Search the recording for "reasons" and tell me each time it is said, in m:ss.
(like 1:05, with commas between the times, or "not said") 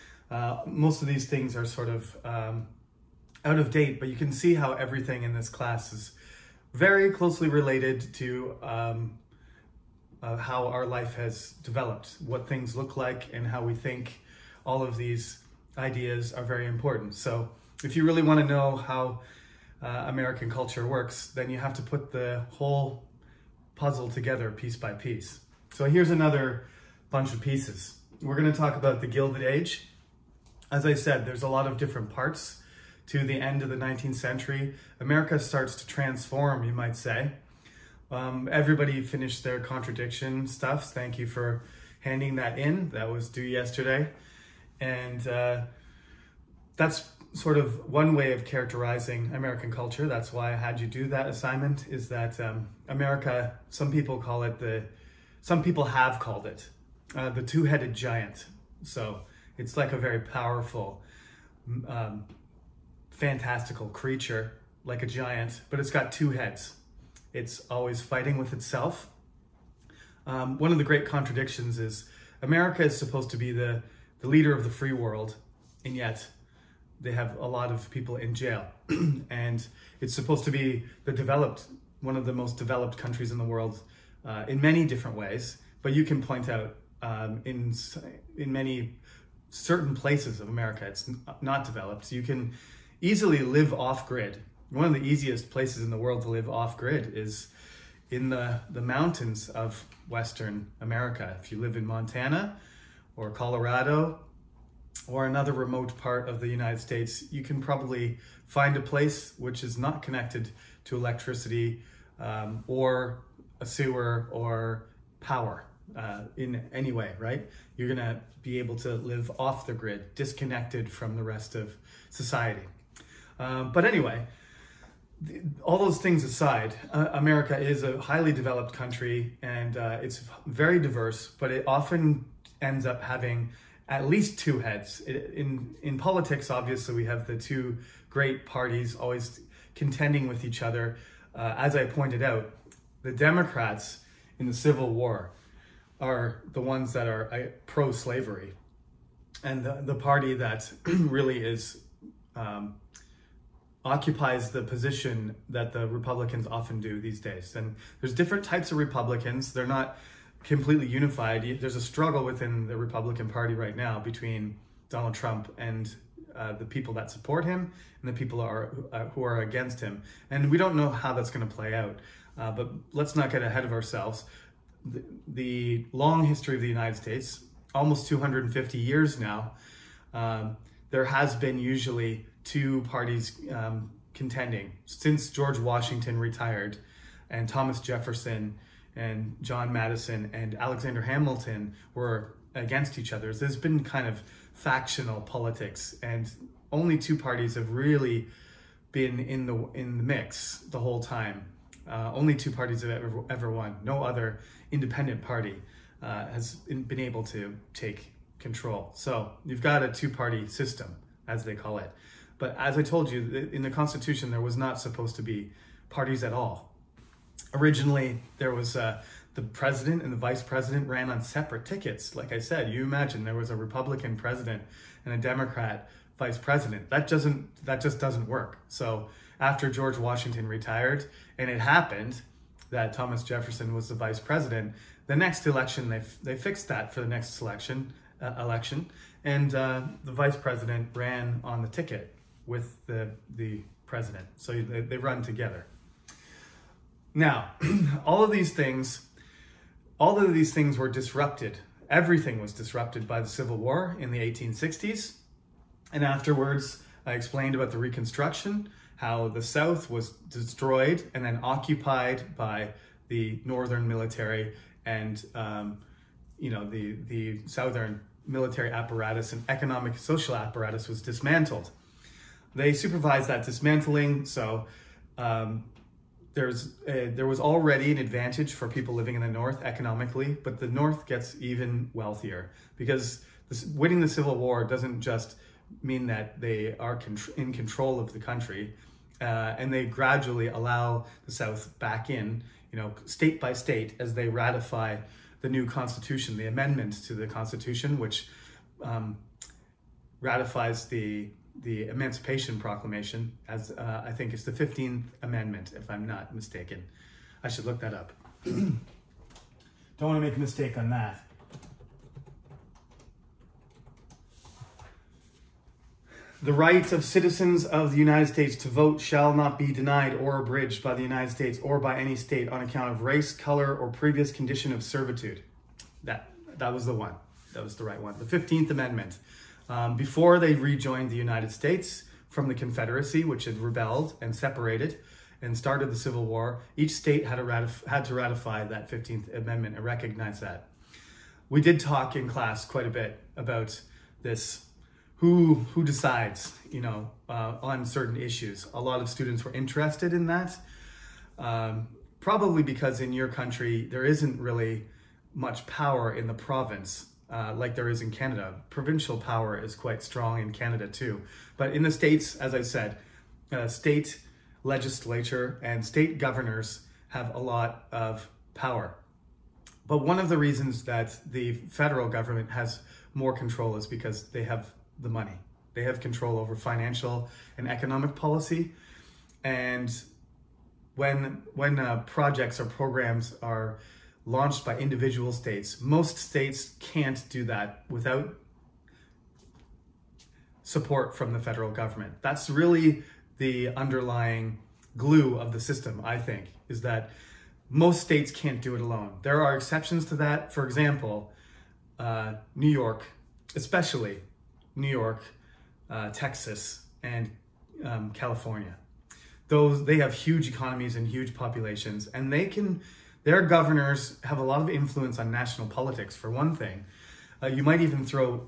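6:10.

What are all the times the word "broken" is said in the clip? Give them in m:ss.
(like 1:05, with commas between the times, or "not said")
not said.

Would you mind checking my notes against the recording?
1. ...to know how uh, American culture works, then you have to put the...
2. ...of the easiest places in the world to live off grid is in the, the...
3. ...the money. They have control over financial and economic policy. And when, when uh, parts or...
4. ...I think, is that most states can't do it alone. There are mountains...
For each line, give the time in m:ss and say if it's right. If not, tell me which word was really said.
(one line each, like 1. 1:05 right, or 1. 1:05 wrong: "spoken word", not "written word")
1. 0:18 right
2. 1:34 right
3. 6:14 wrong: "projects", not "parts"
4. 6:36 wrong: "exceptions", not "mountains".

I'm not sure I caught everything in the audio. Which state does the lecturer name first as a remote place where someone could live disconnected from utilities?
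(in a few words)
Montana.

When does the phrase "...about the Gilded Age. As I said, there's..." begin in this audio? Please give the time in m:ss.
0:28.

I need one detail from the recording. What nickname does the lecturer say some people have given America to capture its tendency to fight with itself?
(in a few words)
the two-headed giant.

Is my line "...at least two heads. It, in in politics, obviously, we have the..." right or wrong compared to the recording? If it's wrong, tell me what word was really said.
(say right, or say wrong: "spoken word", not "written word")
right.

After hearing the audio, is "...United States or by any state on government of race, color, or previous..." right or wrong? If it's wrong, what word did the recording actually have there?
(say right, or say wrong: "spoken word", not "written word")
wrong: "account", not "government".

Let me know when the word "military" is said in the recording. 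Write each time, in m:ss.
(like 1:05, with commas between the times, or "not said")
4:23, 4:28.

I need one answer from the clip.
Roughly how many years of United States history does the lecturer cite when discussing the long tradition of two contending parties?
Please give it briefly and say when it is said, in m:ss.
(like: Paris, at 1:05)
almost 250 years, at 2:57.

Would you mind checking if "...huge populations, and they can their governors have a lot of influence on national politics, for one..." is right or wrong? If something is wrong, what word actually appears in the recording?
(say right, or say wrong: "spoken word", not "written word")
right.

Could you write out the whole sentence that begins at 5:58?
Provincial power is quite strong in Canada too.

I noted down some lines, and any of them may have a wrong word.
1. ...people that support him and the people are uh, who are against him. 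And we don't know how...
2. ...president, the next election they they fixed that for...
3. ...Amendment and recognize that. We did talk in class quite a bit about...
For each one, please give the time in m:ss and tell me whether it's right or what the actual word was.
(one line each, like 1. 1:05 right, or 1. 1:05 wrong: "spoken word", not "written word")
1. 2:46 right
2. 3:54 right
3. 5:39 right.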